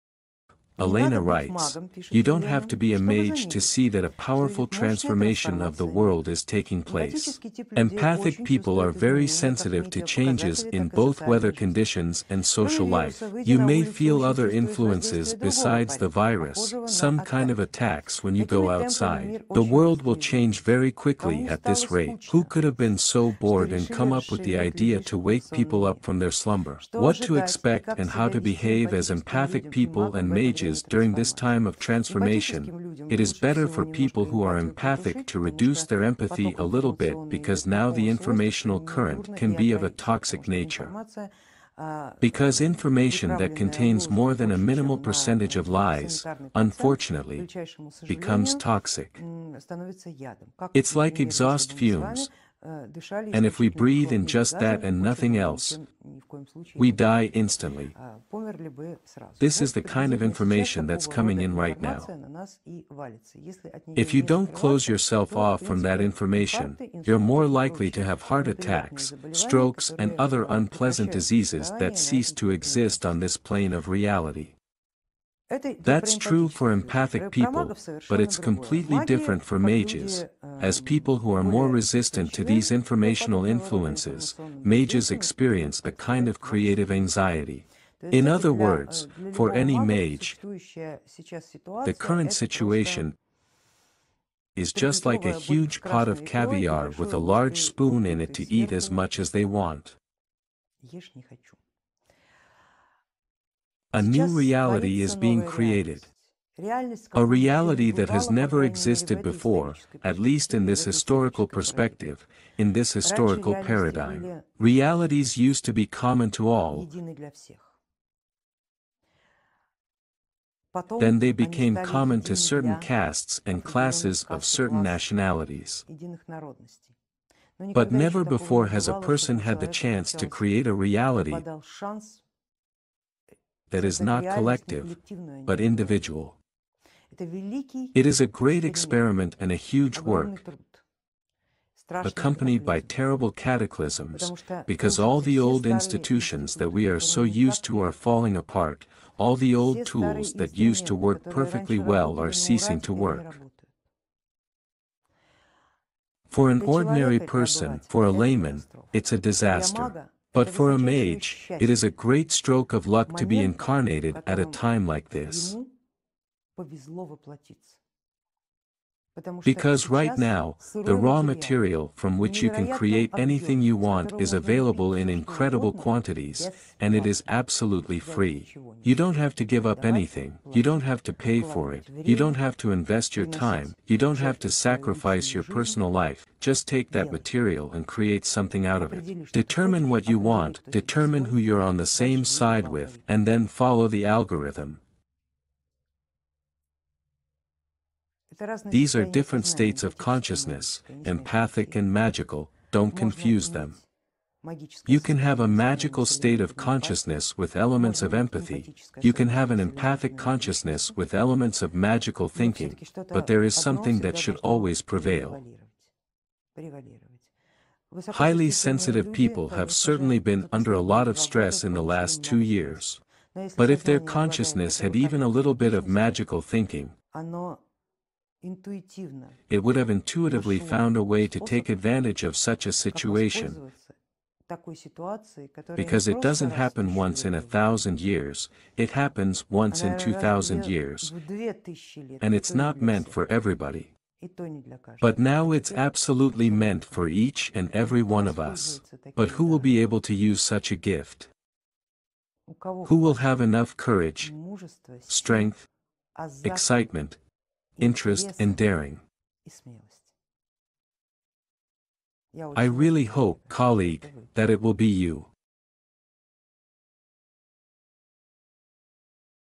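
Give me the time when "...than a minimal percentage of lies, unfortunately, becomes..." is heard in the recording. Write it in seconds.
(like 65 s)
44 s.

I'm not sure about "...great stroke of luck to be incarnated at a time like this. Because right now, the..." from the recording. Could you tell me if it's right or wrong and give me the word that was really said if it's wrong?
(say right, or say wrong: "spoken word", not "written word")
right.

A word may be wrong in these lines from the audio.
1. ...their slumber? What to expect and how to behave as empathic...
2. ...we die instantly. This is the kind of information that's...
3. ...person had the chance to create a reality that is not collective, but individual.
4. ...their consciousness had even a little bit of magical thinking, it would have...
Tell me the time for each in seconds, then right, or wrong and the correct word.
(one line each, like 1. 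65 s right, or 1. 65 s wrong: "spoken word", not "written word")
1. 26 s right
2. 56 s right
3. 129 s right
4. 223 s right.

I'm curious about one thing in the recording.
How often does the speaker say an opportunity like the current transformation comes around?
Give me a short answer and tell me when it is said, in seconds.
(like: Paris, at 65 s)
Once in 2,000 years, at 239 s.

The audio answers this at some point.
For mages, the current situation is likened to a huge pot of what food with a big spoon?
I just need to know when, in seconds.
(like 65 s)
96 s.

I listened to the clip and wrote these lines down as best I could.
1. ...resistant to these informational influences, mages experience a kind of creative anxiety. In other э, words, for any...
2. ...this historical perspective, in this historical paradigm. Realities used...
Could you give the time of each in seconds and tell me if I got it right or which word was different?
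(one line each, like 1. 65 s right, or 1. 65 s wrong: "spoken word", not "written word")
1. 81 s right
2. 110 s right.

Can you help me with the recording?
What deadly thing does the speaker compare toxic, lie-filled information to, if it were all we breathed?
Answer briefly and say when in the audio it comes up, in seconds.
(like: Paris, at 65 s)
Exhaust fumes, at 51 s.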